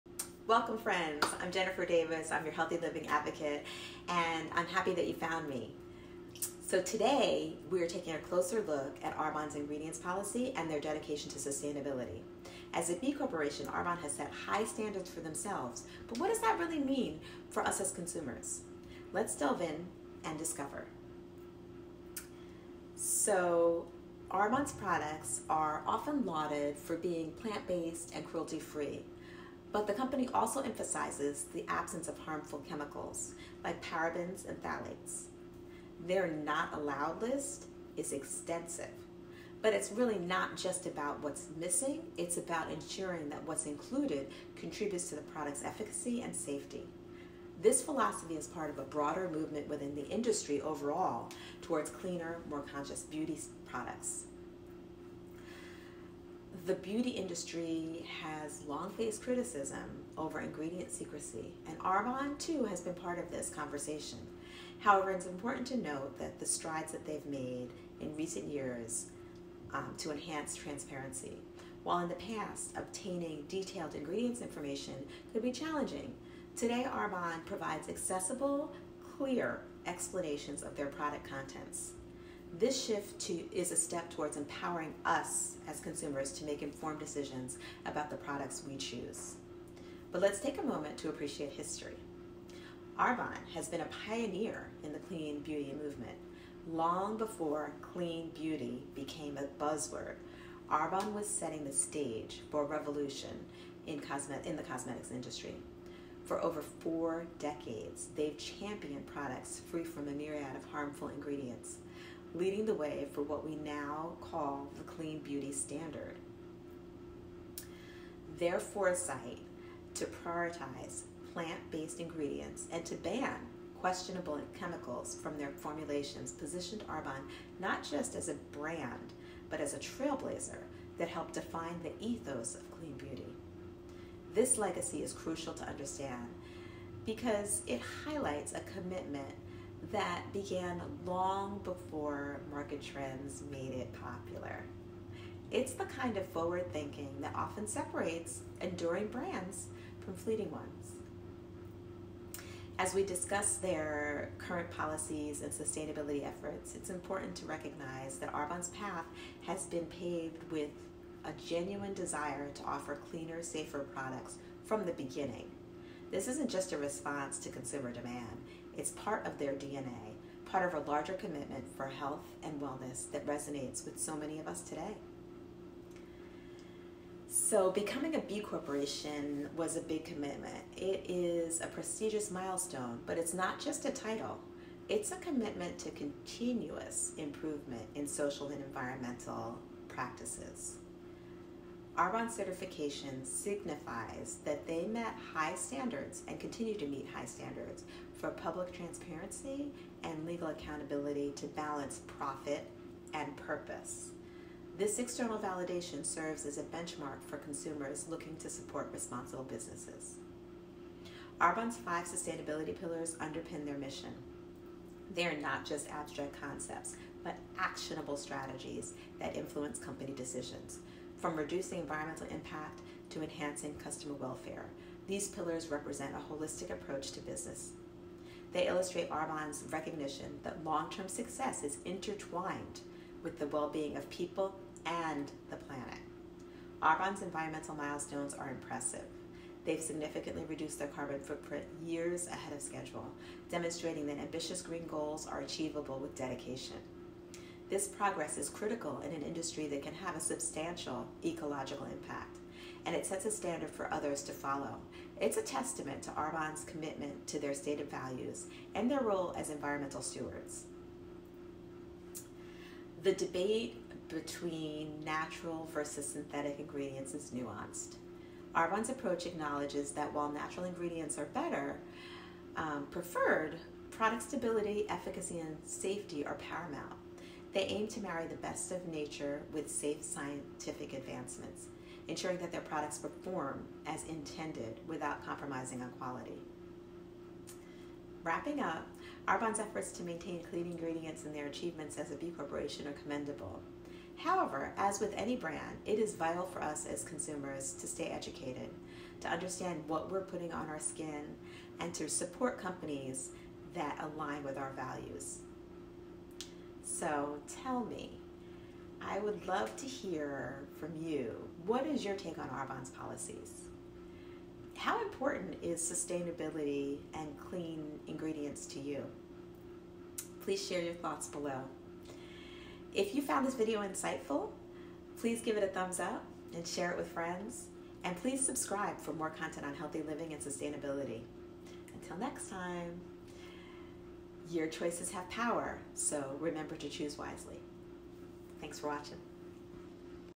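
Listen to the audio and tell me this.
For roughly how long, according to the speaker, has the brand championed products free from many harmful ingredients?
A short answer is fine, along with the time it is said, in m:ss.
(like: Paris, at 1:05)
four decades, at 1:46.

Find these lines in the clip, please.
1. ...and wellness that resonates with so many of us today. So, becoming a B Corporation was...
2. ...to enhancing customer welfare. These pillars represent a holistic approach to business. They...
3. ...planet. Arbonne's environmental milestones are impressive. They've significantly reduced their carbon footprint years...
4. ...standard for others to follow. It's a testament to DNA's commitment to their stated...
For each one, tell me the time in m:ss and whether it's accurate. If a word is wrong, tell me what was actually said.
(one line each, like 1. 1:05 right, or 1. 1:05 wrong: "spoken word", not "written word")
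1. 2:52 right
2. 3:43 right
3. 3:55 right
4. 4:13 wrong: "Arbonne", not "DNA".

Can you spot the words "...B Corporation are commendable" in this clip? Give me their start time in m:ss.
4:52.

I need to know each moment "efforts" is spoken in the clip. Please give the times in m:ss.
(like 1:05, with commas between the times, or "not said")
2:36, 4:49.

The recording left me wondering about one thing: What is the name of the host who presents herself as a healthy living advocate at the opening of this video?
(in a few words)
Jennifer Davis.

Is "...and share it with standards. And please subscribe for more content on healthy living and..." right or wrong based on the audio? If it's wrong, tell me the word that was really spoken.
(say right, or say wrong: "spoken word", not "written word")
wrong: "friends", not "standards".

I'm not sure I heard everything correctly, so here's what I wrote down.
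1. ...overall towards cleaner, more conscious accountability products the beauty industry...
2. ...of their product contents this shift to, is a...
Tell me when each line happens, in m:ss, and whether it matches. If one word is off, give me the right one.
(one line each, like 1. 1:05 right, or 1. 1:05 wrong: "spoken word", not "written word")
1. 0:50 wrong: "beauty", not "accountability"
2. 1:20 right.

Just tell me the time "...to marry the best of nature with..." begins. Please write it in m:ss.
4:37.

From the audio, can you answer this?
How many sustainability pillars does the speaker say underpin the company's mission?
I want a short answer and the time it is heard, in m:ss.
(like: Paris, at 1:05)
5, at 3:31.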